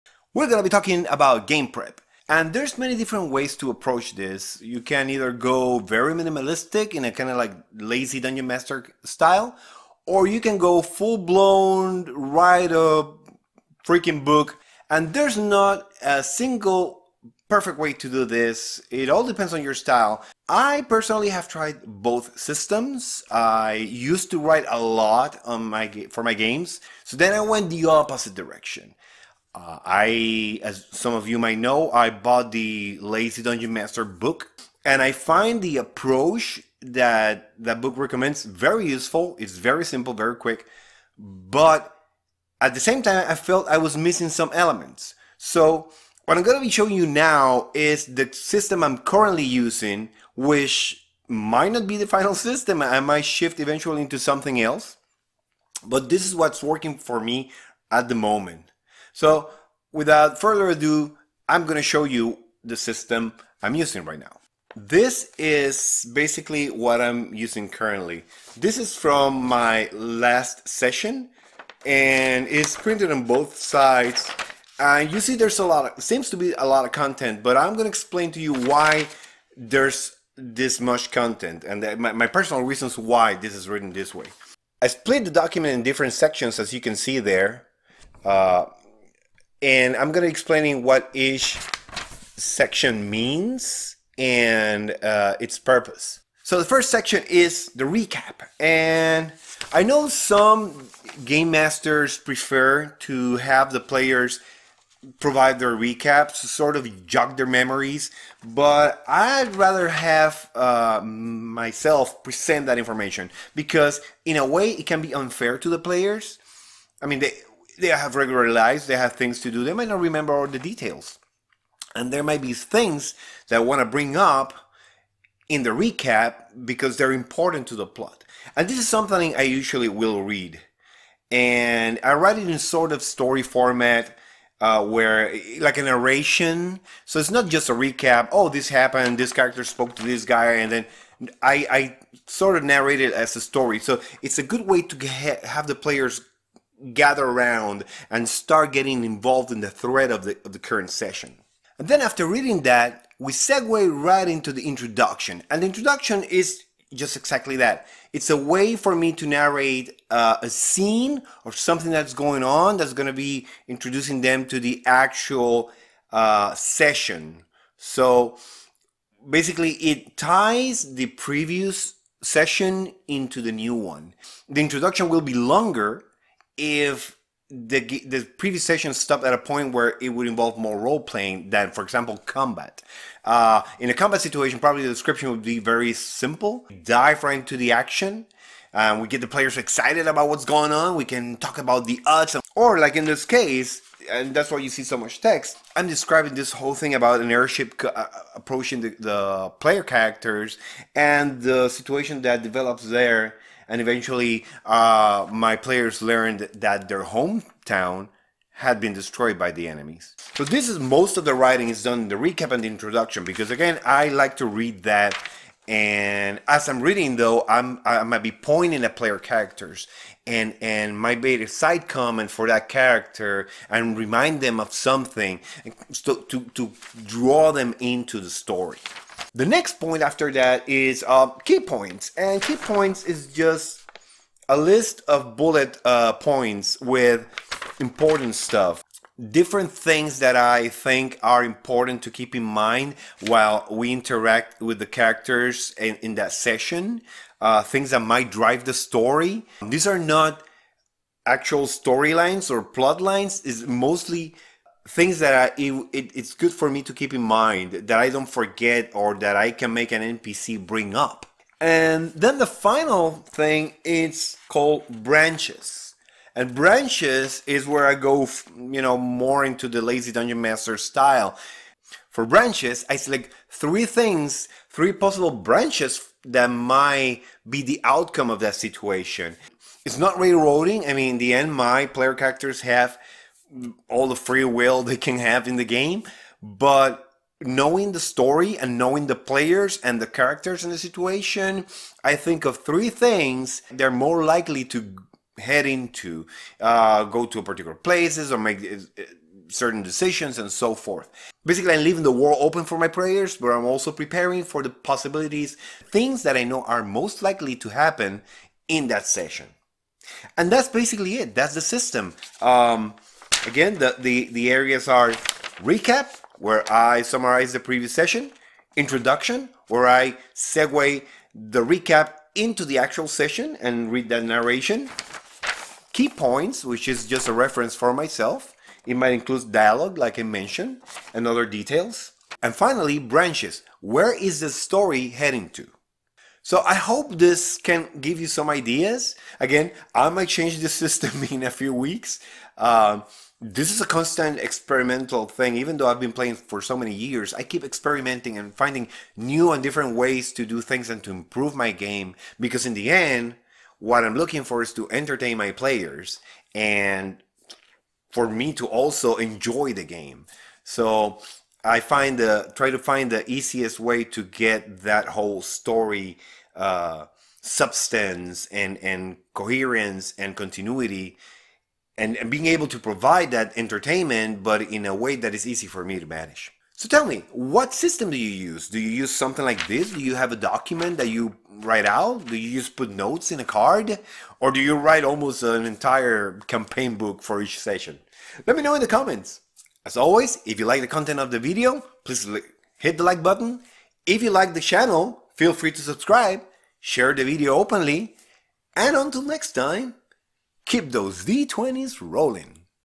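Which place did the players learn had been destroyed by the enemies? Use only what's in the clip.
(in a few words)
Their hometown.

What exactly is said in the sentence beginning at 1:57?
I mean, they, they have regular lives, they have things to do, they might not remember all the details.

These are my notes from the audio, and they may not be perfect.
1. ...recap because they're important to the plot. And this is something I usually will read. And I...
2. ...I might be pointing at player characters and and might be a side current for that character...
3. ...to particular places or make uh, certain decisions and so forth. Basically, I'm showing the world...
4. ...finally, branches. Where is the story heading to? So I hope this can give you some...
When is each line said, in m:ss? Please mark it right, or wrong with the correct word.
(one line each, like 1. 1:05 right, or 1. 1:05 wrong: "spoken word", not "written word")
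1. 2:05 right
2. 3:37 wrong: "comment", not "current"
3. 4:57 wrong: "leaving", not "showing"
4. 5:32 right.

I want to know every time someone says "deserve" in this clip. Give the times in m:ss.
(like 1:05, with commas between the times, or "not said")
not said.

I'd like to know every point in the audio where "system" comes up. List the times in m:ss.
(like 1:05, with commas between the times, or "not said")
0:22, 0:48, 0:52, 1:02, 5:11, 5:40, 6:17.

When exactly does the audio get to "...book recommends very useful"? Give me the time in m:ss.
0:37.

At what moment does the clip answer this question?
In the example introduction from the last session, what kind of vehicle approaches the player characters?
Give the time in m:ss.
3:17.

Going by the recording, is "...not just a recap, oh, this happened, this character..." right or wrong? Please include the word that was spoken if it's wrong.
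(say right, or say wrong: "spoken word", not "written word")
right.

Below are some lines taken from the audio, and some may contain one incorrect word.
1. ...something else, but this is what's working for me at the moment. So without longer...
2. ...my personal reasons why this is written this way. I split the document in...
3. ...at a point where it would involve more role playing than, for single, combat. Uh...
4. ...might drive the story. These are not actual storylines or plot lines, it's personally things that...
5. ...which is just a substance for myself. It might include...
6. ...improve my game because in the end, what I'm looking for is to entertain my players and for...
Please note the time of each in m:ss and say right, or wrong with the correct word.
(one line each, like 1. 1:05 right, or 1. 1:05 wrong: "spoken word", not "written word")
1. 0:54 wrong: "further", not "longer"
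2. 1:22 right
3. 2:59 wrong: "example", not "single"
4. 4:07 wrong: "mostly", not "personally"
5. 5:26 wrong: "reference", not "substance"
6. 5:51 right.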